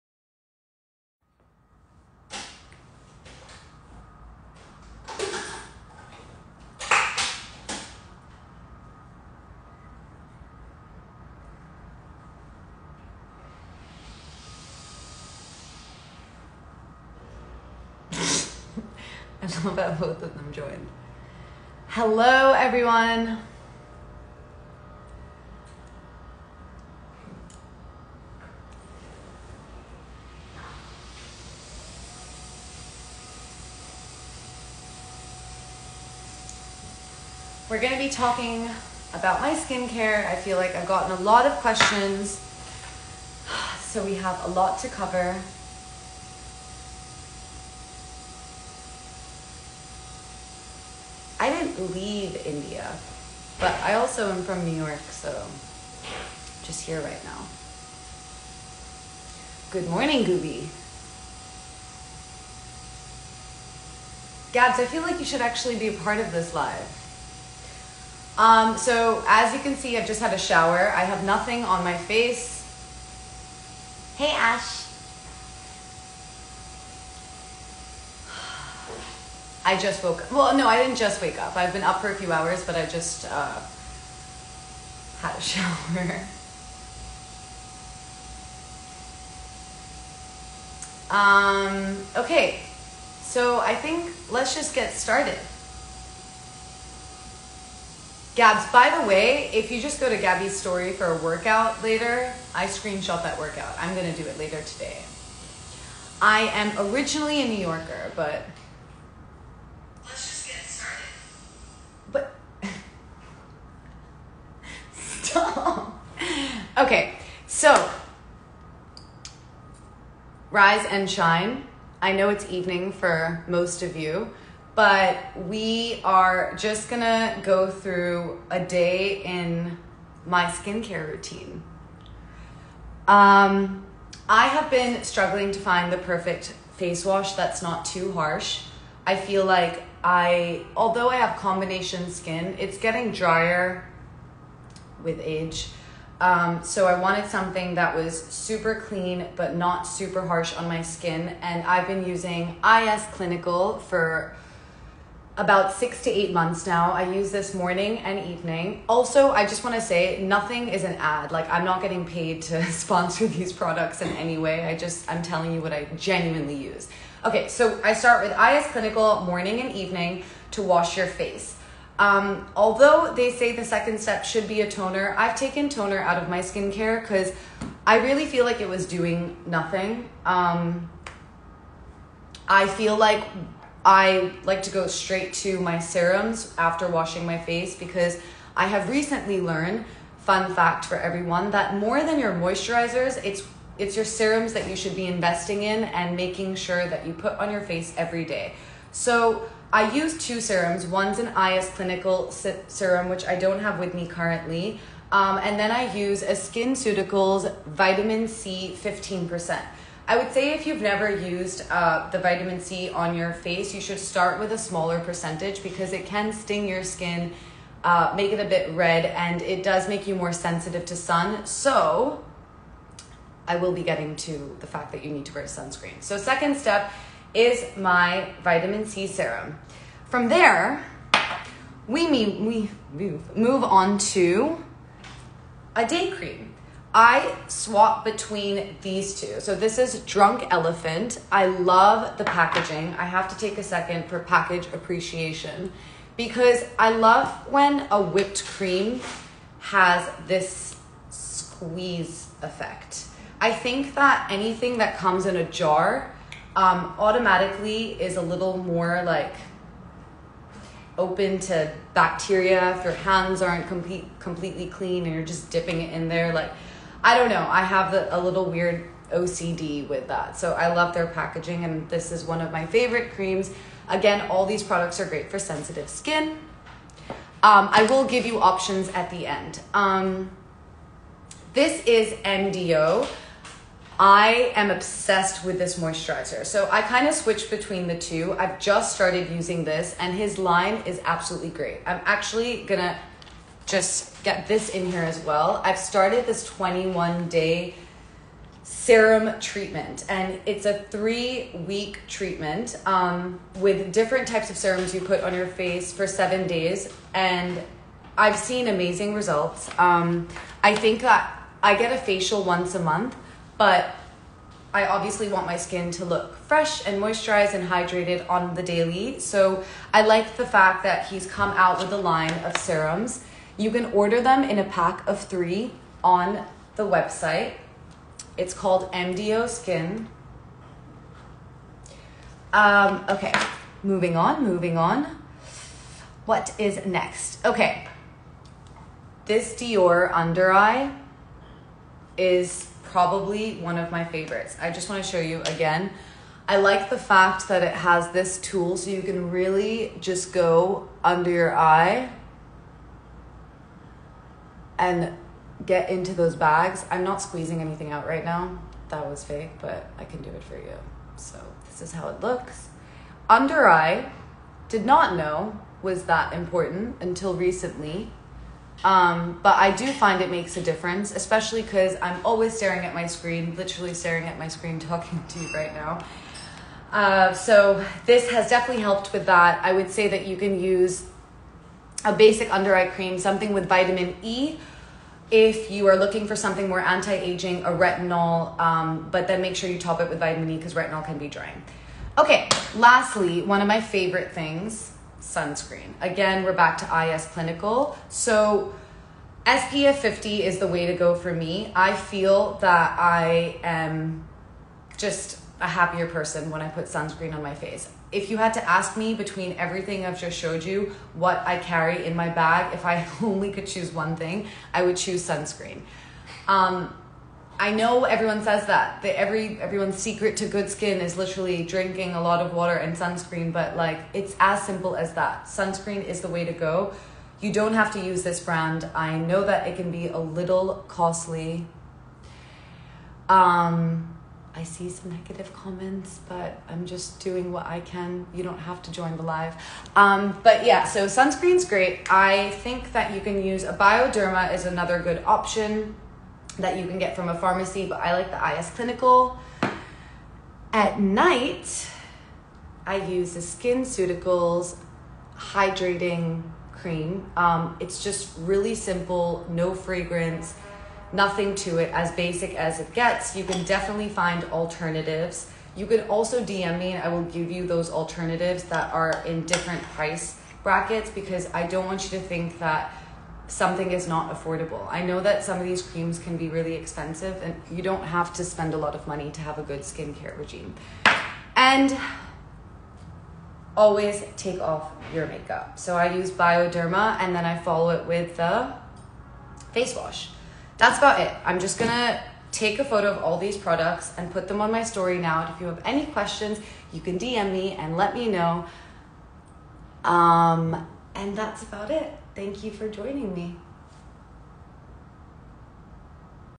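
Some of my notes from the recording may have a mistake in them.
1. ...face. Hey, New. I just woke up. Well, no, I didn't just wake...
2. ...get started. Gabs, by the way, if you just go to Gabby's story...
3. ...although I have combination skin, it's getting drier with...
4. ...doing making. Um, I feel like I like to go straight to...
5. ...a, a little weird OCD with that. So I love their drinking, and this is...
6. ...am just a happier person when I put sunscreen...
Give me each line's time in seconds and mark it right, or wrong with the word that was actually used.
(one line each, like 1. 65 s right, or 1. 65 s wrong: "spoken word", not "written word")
1. 71 s wrong: "Ash", not "New"
2. 94 s right
3. 140 s right
4. 178 s wrong: "nothing", not "making"
5. 267 s wrong: "packaging", not "drinking"
6. 403 s right.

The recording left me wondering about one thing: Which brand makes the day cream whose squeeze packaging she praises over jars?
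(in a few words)
Drunk Elephant.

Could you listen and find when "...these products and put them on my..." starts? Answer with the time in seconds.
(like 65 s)
493 s.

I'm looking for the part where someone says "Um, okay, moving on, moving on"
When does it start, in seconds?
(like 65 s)
332 s.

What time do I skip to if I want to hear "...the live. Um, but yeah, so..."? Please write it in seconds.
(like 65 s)
439 s.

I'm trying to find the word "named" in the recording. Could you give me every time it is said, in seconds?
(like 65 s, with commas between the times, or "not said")
not said.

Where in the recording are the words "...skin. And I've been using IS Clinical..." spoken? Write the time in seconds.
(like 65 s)
150 s.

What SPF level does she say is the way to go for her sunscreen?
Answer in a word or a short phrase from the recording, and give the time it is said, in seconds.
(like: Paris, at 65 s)
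50, at 399 s.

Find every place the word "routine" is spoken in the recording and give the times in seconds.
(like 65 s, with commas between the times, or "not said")
131 s.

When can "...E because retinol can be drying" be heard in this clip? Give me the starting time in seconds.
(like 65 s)
390 s.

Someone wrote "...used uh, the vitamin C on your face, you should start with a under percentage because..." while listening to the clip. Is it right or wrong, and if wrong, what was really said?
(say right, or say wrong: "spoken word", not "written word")
wrong: "smaller", not "under".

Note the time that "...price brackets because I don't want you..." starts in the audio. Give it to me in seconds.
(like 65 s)
469 s.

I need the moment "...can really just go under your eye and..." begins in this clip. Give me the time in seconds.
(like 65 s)
349 s.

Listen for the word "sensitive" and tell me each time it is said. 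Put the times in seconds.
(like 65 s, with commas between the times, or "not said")
220 s, 275 s.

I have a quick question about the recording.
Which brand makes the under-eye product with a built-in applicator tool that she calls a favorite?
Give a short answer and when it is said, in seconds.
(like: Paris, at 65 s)
Dior, at 339 s.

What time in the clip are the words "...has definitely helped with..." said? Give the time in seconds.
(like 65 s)
378 s.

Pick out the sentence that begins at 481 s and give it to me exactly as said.
And always take off your makeup.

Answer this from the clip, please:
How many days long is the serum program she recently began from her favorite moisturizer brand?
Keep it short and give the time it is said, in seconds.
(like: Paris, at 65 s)
21, at 296 s.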